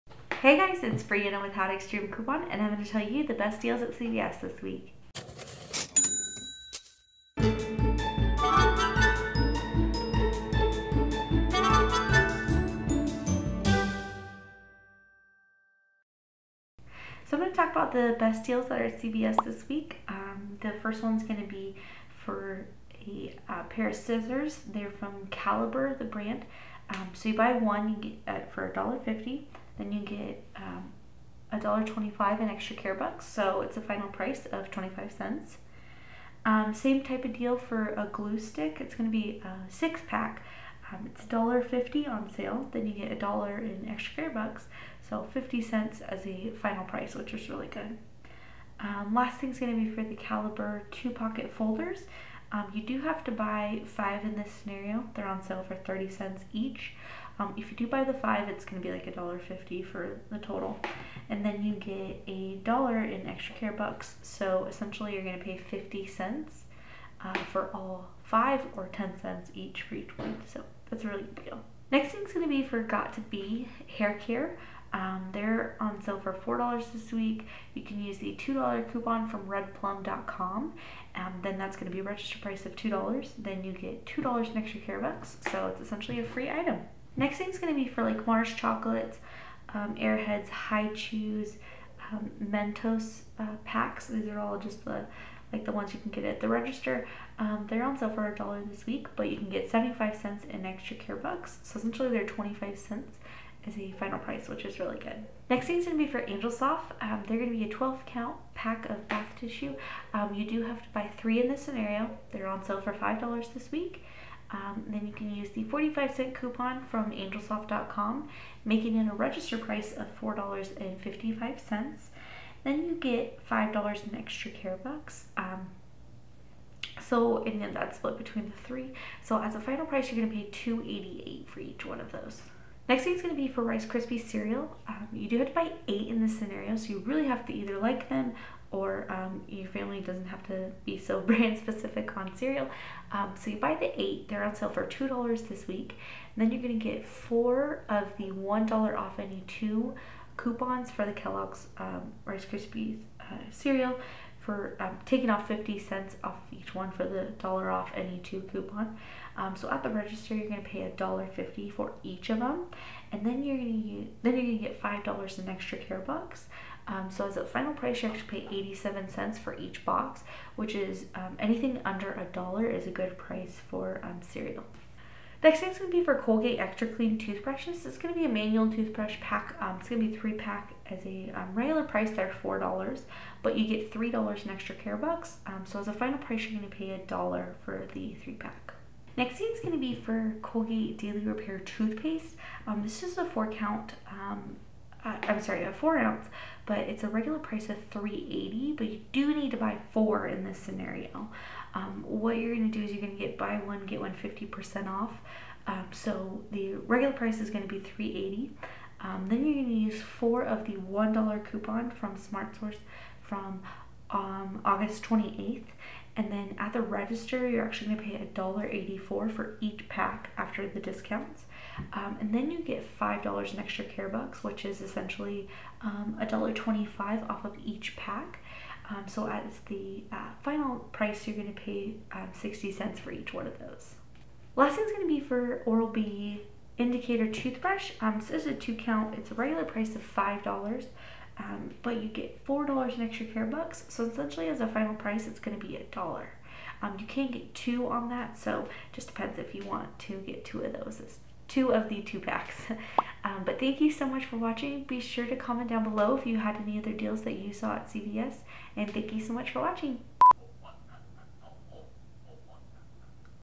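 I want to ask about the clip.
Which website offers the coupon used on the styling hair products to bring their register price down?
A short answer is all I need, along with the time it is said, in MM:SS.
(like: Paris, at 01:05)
redplum.com, at 01:19.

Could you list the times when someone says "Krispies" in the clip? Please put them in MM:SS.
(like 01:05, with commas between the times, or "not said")
02:13, 02:32.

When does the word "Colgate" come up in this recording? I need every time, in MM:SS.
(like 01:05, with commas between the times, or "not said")
02:56, 03:10.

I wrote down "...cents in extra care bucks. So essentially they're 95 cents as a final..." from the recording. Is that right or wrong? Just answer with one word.
wrong.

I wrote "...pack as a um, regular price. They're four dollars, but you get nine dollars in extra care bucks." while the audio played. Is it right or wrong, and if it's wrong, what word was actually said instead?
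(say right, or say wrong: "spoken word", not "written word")
wrong: "three", not "nine".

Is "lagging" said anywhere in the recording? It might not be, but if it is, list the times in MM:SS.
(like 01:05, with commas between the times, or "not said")
not said.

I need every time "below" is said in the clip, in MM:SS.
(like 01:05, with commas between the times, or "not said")
04:15.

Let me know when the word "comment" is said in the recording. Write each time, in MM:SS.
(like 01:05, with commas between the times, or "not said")
04:15.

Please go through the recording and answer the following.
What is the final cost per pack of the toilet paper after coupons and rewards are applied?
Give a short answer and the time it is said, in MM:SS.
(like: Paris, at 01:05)
$2.88, at 02:10.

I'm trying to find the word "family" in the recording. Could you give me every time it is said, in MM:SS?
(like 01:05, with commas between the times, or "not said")
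02:19.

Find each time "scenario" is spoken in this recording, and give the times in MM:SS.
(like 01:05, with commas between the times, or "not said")
00:54, 01:51, 02:16, 03:20.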